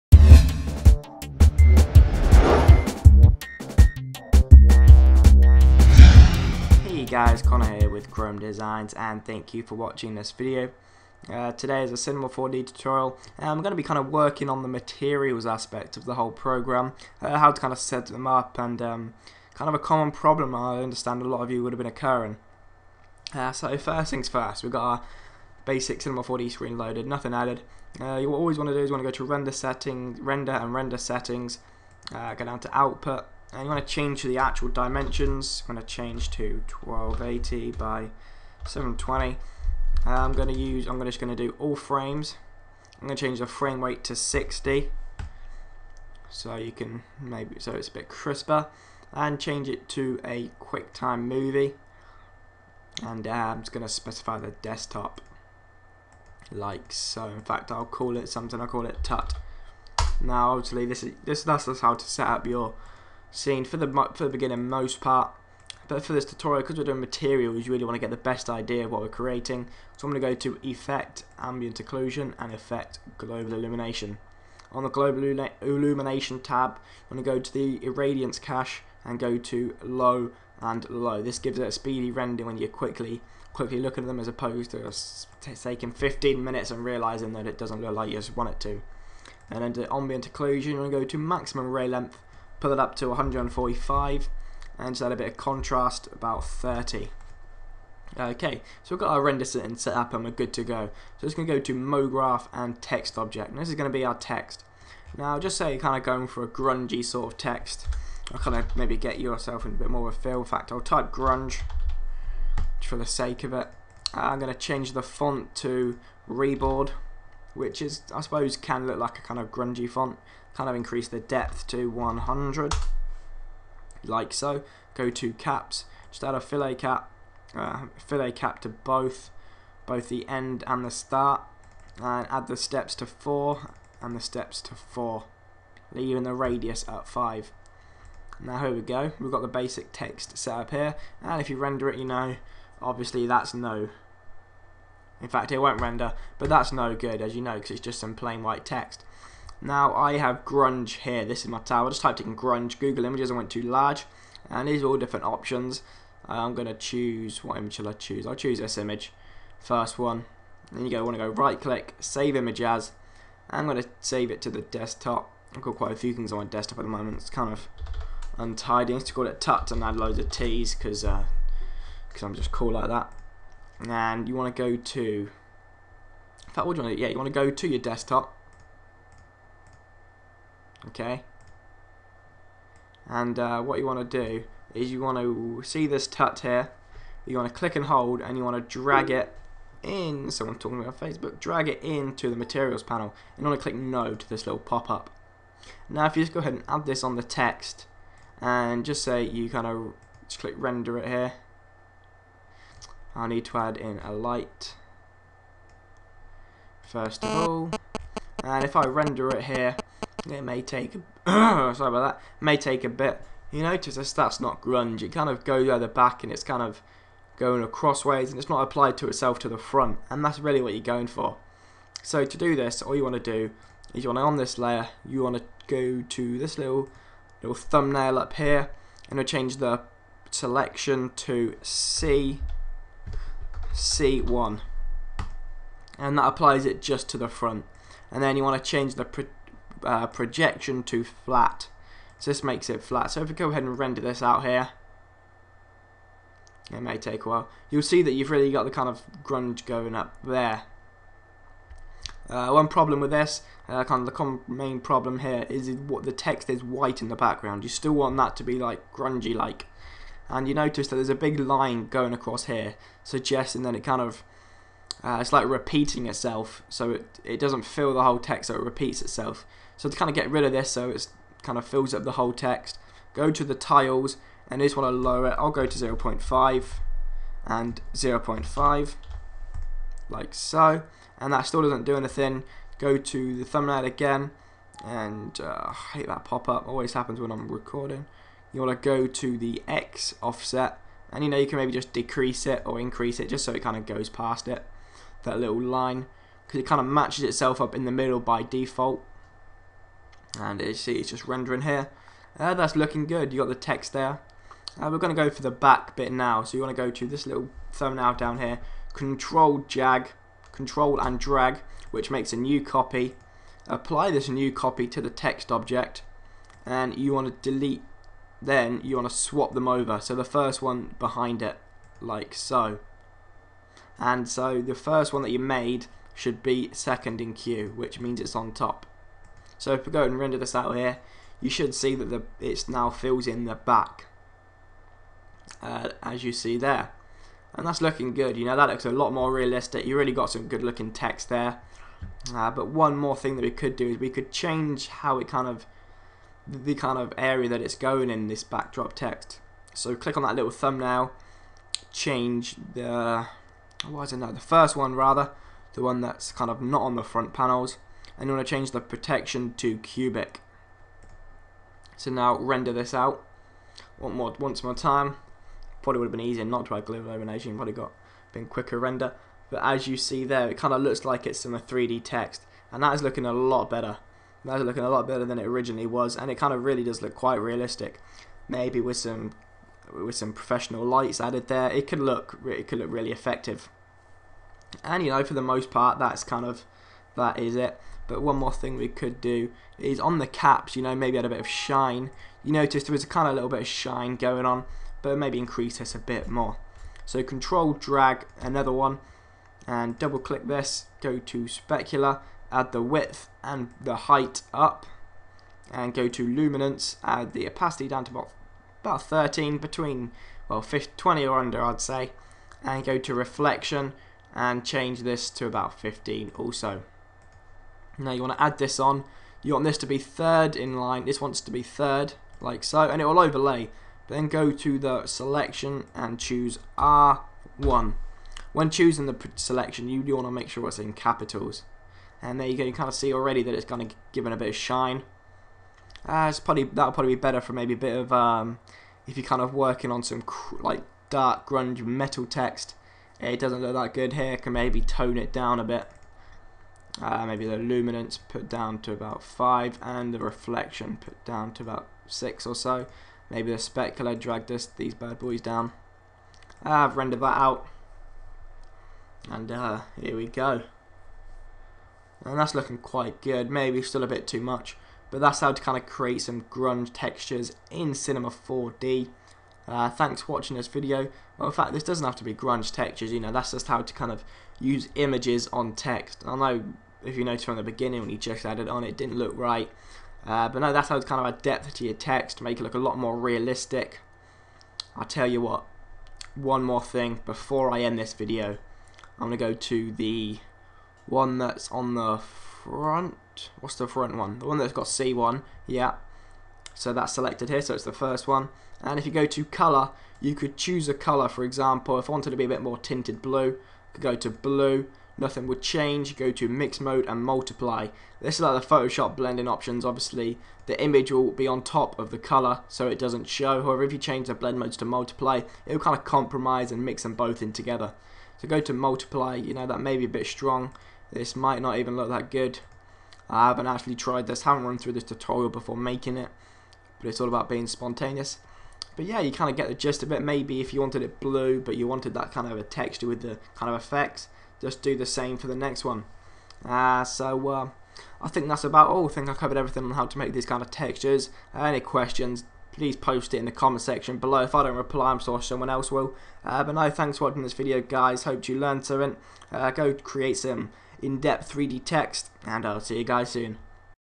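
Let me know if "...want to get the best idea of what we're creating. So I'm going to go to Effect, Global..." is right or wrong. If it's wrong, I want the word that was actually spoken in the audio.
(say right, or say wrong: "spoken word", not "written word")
wrong: "Ambient", not "Global".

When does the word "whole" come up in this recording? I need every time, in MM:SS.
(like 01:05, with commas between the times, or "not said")
00:16, 04:28, 04:32.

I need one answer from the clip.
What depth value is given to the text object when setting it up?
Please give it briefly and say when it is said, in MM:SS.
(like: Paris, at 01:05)
100, at 02:01.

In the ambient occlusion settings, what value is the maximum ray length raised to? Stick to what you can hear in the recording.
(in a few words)
145.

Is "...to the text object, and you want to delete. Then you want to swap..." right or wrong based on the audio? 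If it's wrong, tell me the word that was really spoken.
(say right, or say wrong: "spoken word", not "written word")
right.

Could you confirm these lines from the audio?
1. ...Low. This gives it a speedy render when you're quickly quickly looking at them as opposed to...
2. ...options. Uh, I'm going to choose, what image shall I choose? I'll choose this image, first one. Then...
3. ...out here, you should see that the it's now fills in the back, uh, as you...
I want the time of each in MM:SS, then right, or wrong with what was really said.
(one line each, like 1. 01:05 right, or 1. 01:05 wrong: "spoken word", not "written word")
1. 01:20 right
2. 02:35 right
3. 05:30 right.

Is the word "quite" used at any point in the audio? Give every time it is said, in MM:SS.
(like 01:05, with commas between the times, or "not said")
02:45, 06:17, 07:42.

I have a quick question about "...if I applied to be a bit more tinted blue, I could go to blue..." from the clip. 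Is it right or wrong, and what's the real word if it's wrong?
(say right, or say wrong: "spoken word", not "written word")
wrong: "wanted", not "applied".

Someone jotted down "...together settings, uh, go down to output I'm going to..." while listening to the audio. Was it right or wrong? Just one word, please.
wrong.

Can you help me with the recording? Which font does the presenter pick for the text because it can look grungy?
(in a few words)
Reboard.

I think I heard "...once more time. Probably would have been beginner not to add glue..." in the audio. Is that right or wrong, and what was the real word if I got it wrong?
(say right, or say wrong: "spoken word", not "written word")
wrong: "easier", not "beginner".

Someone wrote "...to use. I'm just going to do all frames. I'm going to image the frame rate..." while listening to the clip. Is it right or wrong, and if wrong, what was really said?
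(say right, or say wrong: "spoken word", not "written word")
wrong: "change", not "image".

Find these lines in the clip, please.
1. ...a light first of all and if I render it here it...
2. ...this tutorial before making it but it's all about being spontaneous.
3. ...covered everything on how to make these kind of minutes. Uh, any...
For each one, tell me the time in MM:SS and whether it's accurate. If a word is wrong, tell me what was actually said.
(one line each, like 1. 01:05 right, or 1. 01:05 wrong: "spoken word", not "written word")
1. 03:24 right
2. 08:44 right
3. 08:59 wrong: "textures", not "minutes".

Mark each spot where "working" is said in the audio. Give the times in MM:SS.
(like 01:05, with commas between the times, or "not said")
00:14, 07:19.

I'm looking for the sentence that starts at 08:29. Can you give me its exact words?
Obviously, the image will be on top of the color, so it doesn't show.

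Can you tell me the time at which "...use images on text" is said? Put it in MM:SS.
07:54.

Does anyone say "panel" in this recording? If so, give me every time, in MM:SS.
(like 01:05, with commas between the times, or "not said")
03:12, 05:57.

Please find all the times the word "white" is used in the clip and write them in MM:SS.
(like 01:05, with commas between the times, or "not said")
02:28, 04:16.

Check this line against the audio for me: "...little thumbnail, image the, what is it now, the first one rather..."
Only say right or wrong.
wrong.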